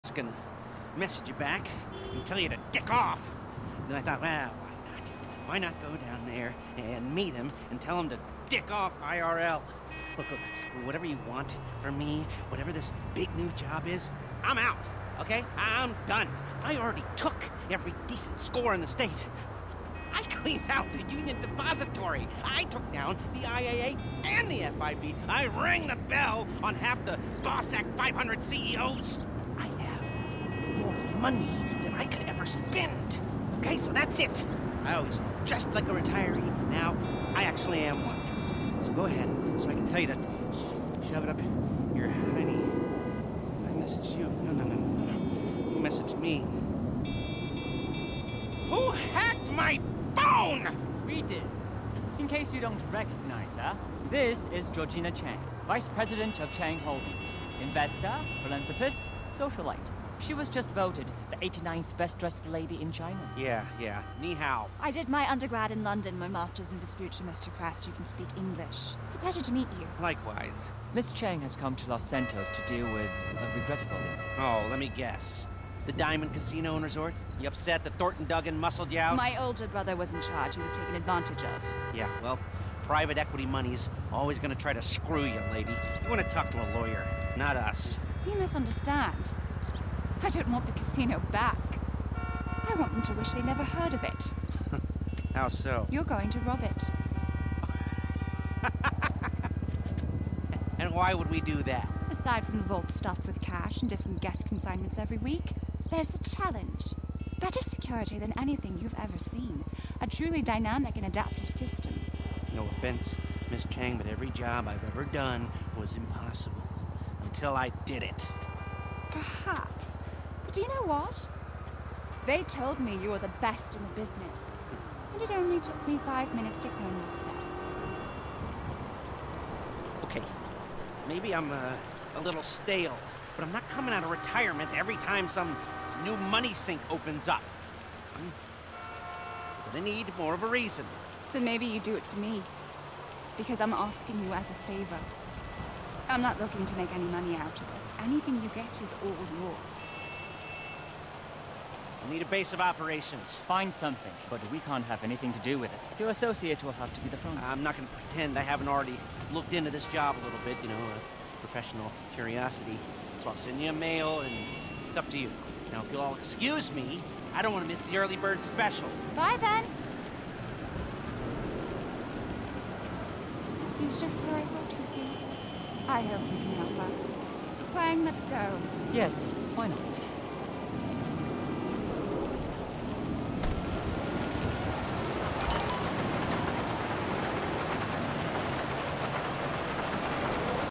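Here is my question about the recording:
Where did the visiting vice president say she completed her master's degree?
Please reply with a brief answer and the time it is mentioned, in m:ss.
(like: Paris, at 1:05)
Vespucci, at 1:06.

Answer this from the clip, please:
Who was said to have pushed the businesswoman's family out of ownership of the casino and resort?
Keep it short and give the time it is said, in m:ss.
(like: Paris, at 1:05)
Thornton Duggan, at 1:17.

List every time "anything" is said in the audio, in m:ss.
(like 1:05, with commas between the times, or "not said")
1:48, 2:28, 2:35.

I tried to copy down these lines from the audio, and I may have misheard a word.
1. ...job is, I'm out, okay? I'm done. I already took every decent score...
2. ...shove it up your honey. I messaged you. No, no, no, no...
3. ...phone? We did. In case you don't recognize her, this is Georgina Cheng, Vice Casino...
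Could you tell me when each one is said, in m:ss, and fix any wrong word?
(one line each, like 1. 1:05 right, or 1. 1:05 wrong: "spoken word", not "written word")
1. 0:13 right
2. 0:41 right
3. 0:50 wrong: "President", not "Casino".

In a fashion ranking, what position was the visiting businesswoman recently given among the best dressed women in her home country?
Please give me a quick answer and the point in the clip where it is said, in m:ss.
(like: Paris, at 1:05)
89th, at 1:01.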